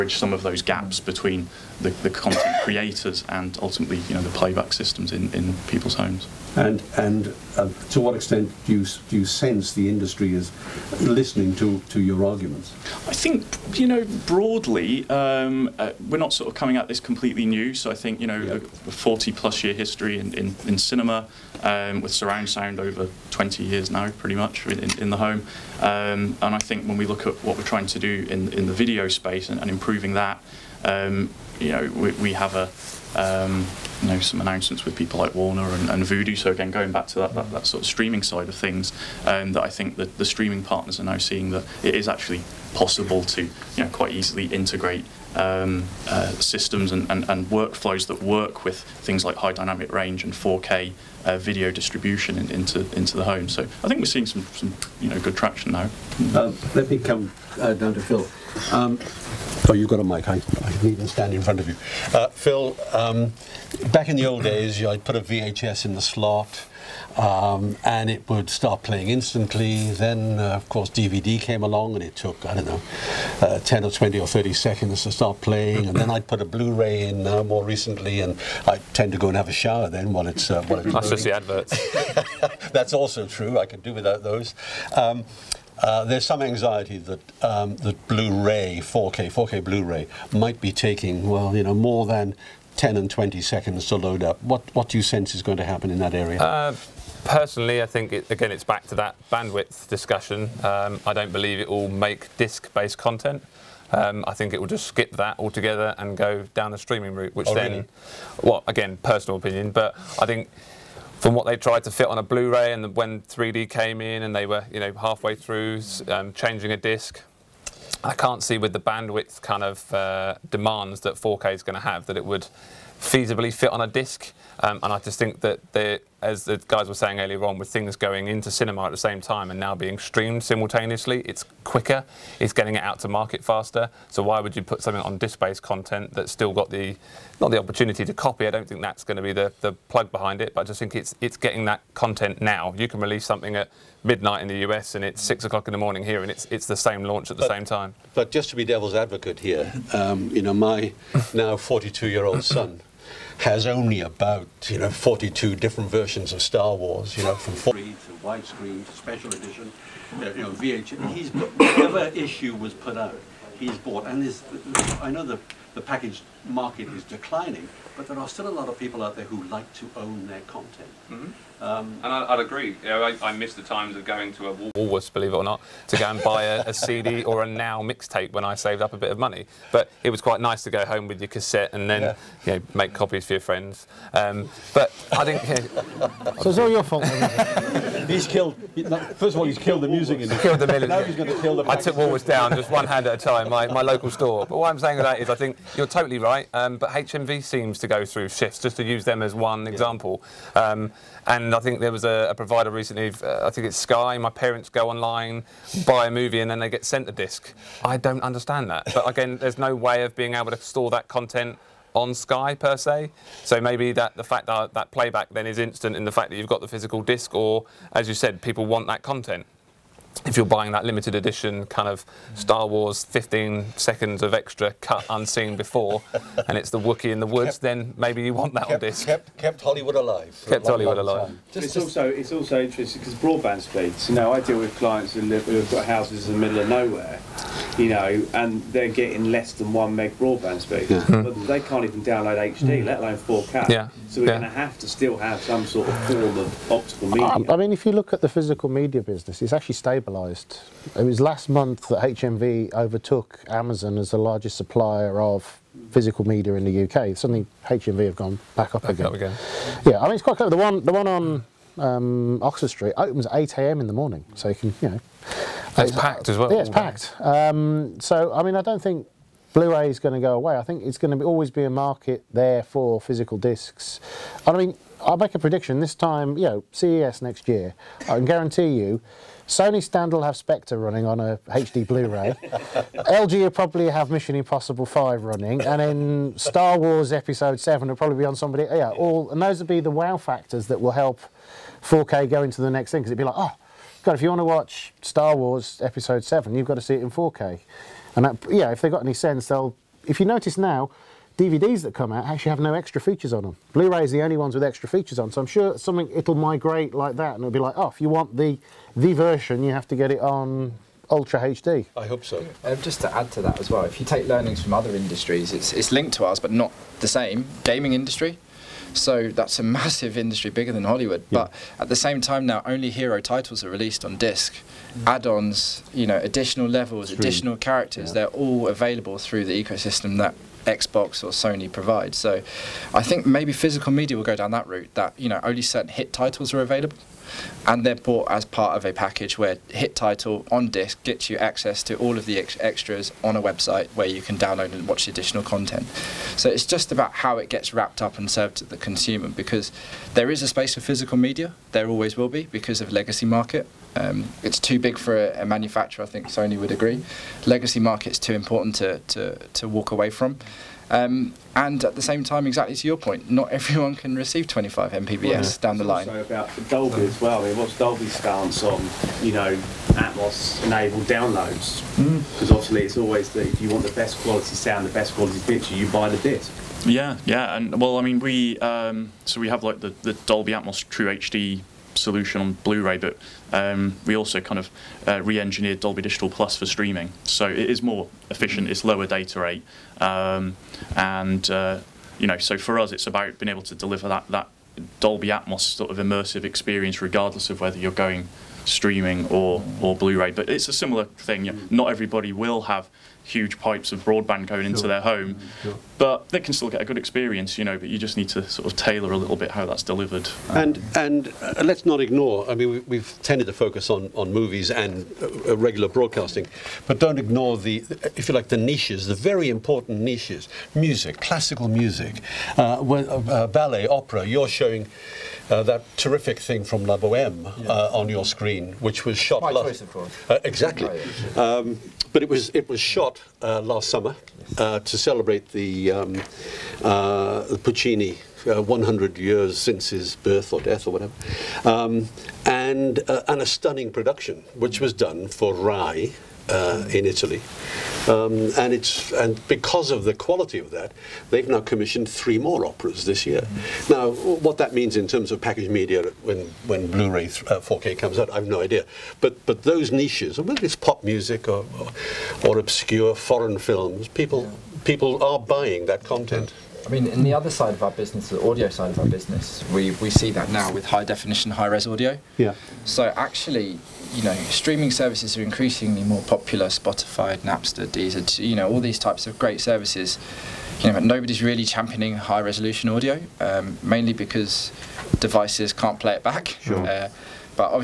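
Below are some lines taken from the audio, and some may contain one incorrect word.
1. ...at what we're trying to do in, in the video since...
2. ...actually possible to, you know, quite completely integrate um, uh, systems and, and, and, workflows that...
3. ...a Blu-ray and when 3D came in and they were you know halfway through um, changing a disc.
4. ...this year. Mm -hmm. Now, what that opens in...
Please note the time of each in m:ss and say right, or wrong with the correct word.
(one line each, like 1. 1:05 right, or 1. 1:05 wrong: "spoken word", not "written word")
1. 0:27 wrong: "space", not "since"
2. 0:42 wrong: "easily", not "completely"
3. 1:52 right
4. 7:33 wrong: "means", not "opens".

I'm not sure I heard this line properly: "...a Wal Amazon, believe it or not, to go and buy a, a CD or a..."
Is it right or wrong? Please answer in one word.
wrong.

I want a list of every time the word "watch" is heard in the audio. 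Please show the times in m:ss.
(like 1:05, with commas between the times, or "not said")
4:54, 5:44.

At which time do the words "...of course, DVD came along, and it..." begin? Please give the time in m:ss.
1:10.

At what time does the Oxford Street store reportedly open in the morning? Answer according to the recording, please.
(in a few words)
8 a.m.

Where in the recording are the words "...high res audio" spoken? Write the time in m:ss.
7:51.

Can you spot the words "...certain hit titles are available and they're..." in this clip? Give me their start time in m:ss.
5:35.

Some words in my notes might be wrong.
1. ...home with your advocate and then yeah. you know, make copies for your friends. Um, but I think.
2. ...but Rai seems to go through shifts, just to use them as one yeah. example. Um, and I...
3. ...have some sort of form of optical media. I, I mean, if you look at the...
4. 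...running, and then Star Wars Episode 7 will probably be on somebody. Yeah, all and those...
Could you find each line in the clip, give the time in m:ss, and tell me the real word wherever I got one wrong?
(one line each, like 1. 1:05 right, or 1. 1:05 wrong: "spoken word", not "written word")
1. 3:00 wrong: "cassette", not "advocate"
2. 3:16 wrong: "HMV", not "Rai"
3. 4:05 right
4. 4:45 right.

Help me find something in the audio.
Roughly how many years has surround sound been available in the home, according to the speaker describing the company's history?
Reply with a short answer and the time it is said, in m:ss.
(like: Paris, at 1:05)
20, at 0:22.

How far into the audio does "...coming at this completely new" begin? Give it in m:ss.
0:16.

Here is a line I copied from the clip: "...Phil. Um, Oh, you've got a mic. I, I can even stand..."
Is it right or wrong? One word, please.
right.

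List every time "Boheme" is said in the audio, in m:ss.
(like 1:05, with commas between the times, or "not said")
7:06.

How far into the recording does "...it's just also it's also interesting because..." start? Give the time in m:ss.
3:51.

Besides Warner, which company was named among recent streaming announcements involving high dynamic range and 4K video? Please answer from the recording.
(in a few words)
Vudu.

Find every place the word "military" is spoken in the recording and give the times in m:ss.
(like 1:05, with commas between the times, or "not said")
3:10.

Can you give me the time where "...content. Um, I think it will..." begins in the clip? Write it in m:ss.
1:42.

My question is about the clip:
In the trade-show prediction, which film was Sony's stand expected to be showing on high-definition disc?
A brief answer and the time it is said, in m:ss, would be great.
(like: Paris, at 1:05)
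Spectre, at 4:40.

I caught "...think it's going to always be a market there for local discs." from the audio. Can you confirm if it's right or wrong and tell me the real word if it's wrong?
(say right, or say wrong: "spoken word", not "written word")
wrong: "physical", not "local".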